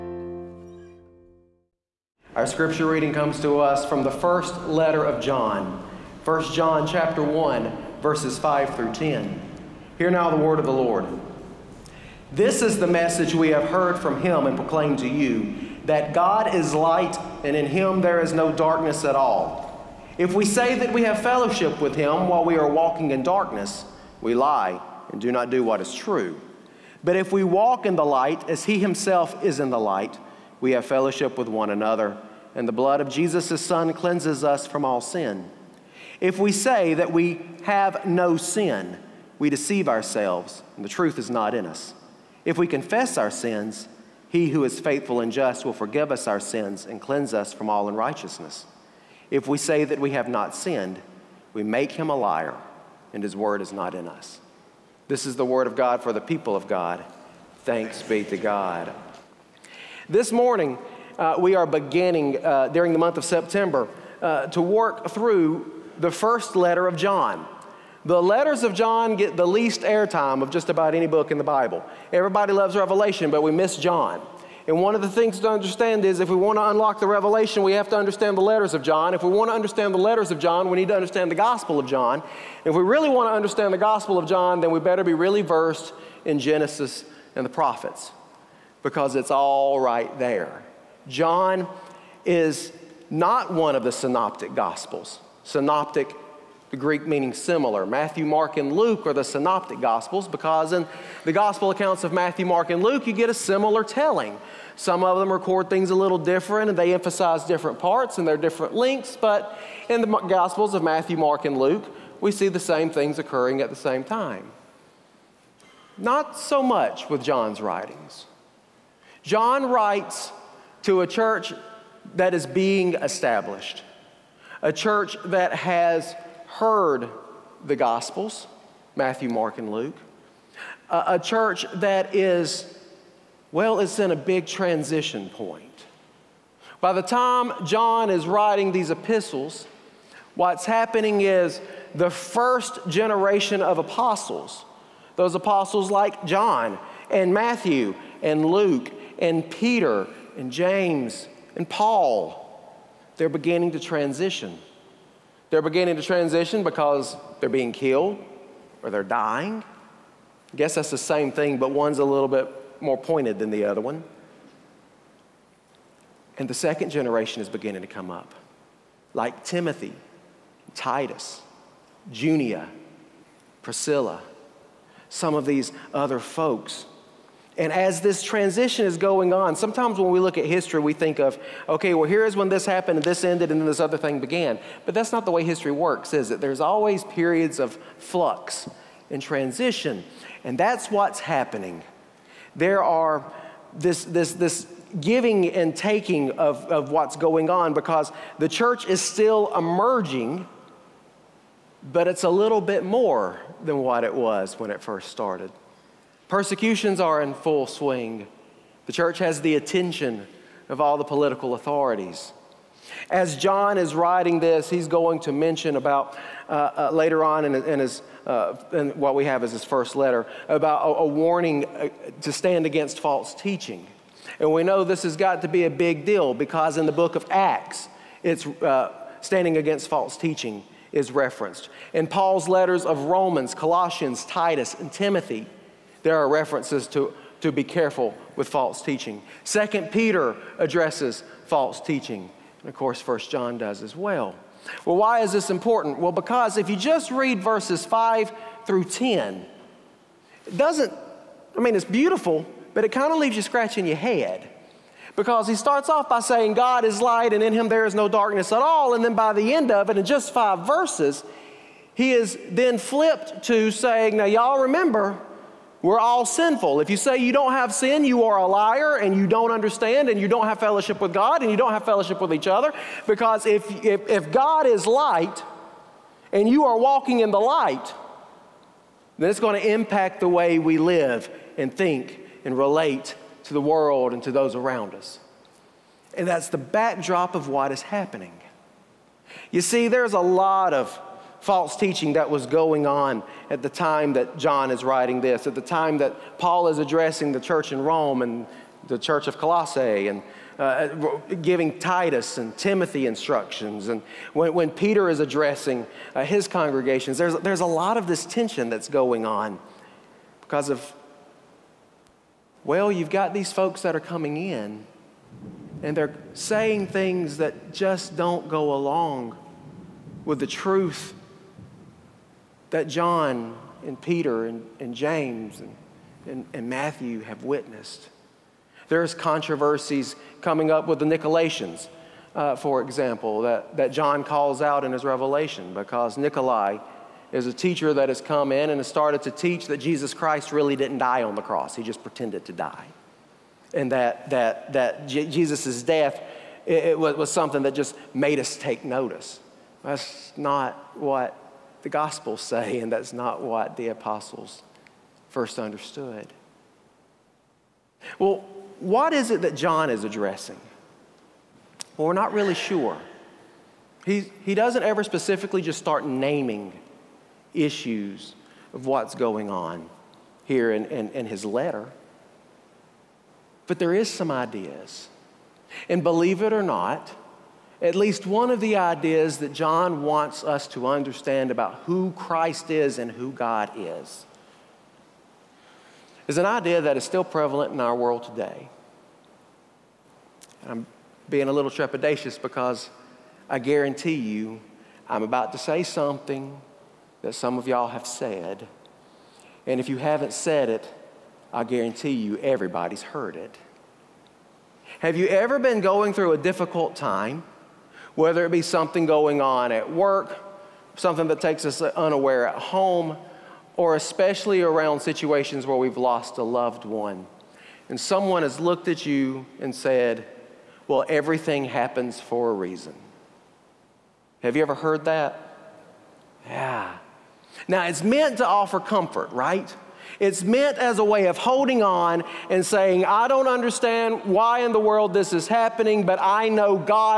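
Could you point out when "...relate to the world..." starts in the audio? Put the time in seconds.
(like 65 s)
282 s.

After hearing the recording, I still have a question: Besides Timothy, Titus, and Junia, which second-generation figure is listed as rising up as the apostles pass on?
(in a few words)
Priscilla.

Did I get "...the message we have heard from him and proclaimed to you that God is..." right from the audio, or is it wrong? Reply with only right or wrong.
right.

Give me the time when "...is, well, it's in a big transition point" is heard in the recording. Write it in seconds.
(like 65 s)
132 s.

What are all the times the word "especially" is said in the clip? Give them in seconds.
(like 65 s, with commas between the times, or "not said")
413 s.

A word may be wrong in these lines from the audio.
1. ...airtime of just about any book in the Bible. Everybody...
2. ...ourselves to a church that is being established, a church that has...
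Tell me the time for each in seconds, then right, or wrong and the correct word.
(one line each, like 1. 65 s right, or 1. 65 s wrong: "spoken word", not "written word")
1. 69 s right
2. 119 s wrong: "writes", not "ourselves".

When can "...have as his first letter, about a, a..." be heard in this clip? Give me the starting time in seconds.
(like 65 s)
219 s.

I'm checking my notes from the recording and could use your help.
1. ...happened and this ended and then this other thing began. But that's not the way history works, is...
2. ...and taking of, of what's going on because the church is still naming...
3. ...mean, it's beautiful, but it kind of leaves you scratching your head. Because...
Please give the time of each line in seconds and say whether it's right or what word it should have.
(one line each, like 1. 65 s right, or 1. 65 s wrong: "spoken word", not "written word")
1. 182 s right
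2. 195 s wrong: "emerging", not "naming"
3. 251 s right.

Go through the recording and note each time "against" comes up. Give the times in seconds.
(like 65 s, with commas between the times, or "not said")
222 s, 229 s.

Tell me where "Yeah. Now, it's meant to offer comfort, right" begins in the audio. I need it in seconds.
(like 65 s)
426 s.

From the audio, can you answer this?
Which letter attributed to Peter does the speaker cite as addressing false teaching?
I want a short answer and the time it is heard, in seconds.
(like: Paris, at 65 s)
Second Peter, at 239 s.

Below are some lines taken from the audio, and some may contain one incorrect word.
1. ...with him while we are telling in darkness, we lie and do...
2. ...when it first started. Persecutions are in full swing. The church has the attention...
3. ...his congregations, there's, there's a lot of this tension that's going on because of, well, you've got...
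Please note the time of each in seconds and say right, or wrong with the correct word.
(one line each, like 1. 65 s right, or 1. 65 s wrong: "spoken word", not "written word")
1. 21 s wrong: "walking", not "telling"
2. 204 s right
3. 306 s right.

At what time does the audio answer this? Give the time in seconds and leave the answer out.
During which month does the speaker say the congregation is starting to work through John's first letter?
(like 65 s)
63 s.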